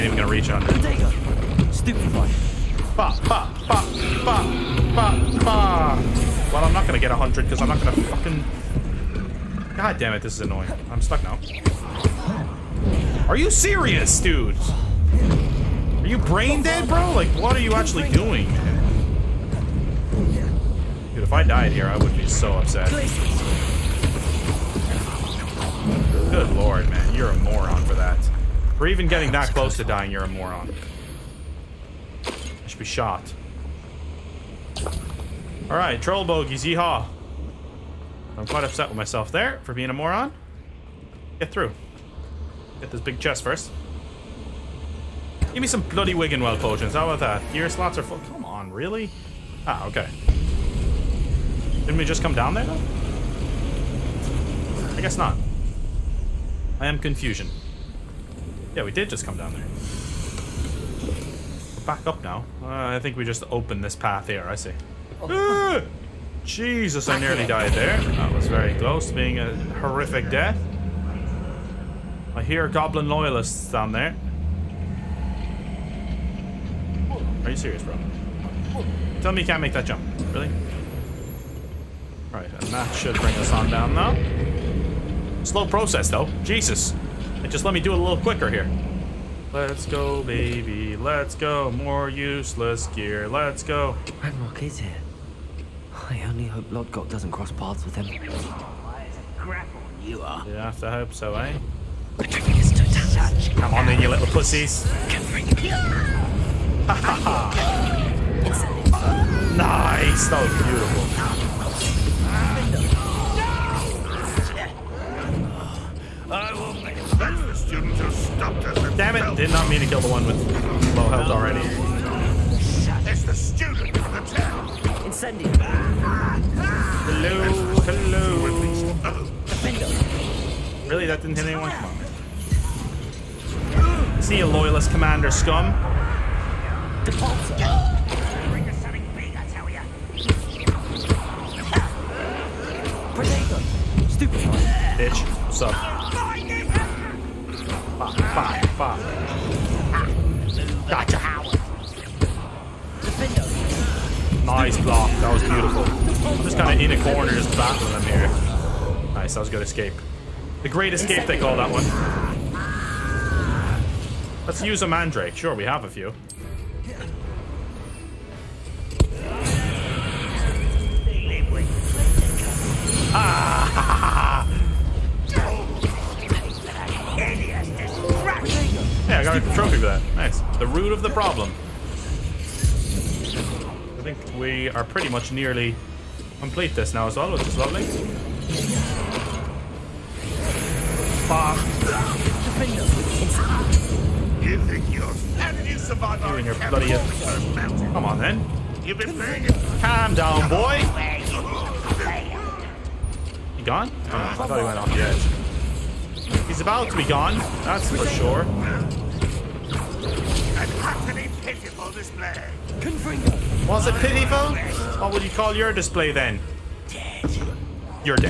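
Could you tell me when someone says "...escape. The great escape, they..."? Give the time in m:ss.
2:39.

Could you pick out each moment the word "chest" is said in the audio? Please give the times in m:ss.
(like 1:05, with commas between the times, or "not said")
0:43.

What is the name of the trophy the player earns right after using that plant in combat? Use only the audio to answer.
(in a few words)
The Root of the Problem.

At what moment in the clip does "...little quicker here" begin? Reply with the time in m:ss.
1:28.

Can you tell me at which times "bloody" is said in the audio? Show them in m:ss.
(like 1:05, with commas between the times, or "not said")
0:45, 3:16.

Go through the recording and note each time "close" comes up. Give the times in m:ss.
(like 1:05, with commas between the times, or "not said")
0:29, 1:08.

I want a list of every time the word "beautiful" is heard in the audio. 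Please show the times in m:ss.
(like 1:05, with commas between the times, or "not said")
1:50, 2:35.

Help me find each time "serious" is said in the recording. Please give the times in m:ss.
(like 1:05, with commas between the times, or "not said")
0:13, 1:17.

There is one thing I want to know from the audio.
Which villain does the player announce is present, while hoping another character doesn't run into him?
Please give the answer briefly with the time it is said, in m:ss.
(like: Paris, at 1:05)
Ranrock, at 1:34.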